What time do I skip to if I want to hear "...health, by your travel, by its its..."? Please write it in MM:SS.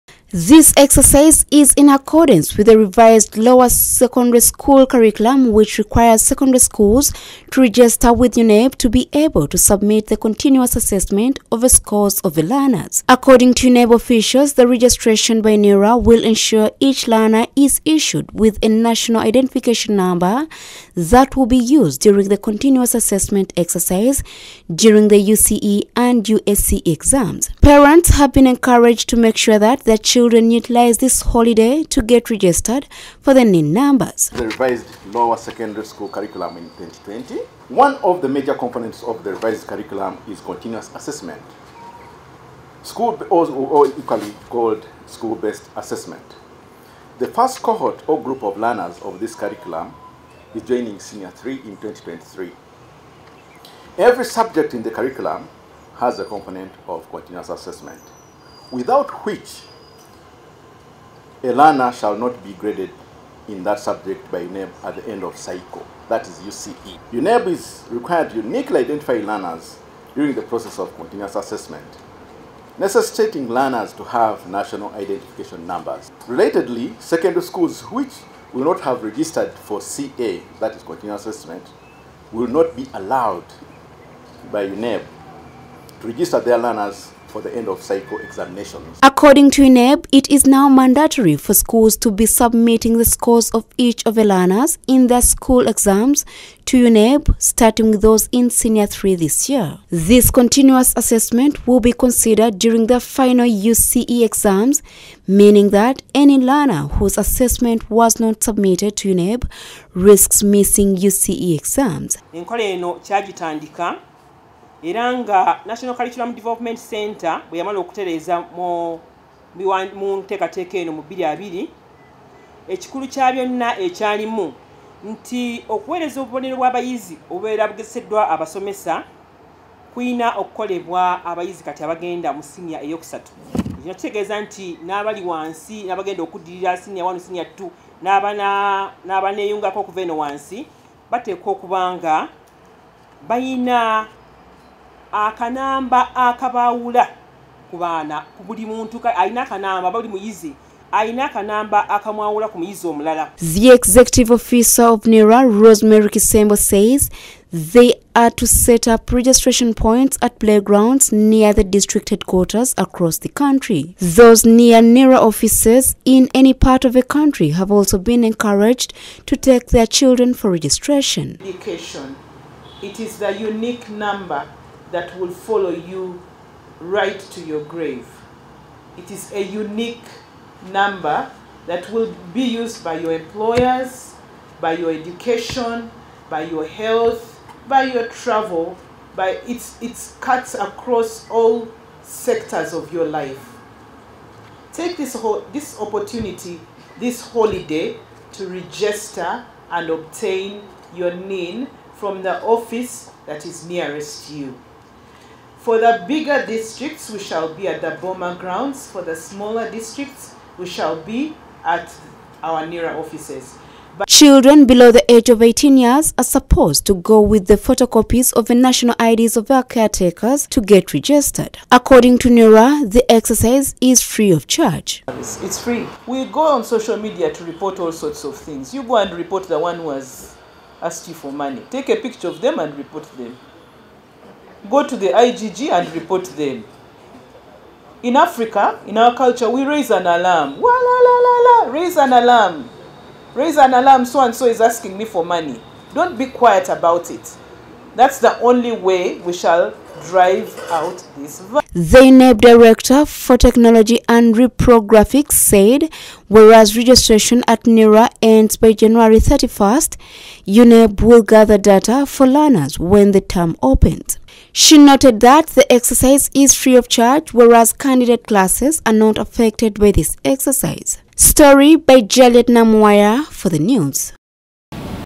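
03:06.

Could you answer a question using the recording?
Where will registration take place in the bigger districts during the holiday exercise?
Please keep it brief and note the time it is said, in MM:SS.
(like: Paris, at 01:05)
Boma grounds, at 03:28.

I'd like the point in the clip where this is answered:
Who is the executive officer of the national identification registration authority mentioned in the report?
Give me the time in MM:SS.
02:35.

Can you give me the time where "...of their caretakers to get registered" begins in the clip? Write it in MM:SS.
03:39.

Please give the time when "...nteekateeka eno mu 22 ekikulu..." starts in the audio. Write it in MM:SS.
02:00.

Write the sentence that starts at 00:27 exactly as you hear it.
Parents have been encouraged to make sure that their children children utilize this holiday to get registered for the NIN numbers.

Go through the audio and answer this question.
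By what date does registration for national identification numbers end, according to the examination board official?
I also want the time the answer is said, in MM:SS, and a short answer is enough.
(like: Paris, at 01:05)
January 31st, at 04:18.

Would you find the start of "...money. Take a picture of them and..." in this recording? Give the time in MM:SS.
03:51.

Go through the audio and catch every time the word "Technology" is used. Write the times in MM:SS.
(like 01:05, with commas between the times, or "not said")
04:13.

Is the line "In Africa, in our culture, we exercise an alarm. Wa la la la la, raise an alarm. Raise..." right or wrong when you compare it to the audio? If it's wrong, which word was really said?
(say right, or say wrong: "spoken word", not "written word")
wrong: "raise", not "exercise".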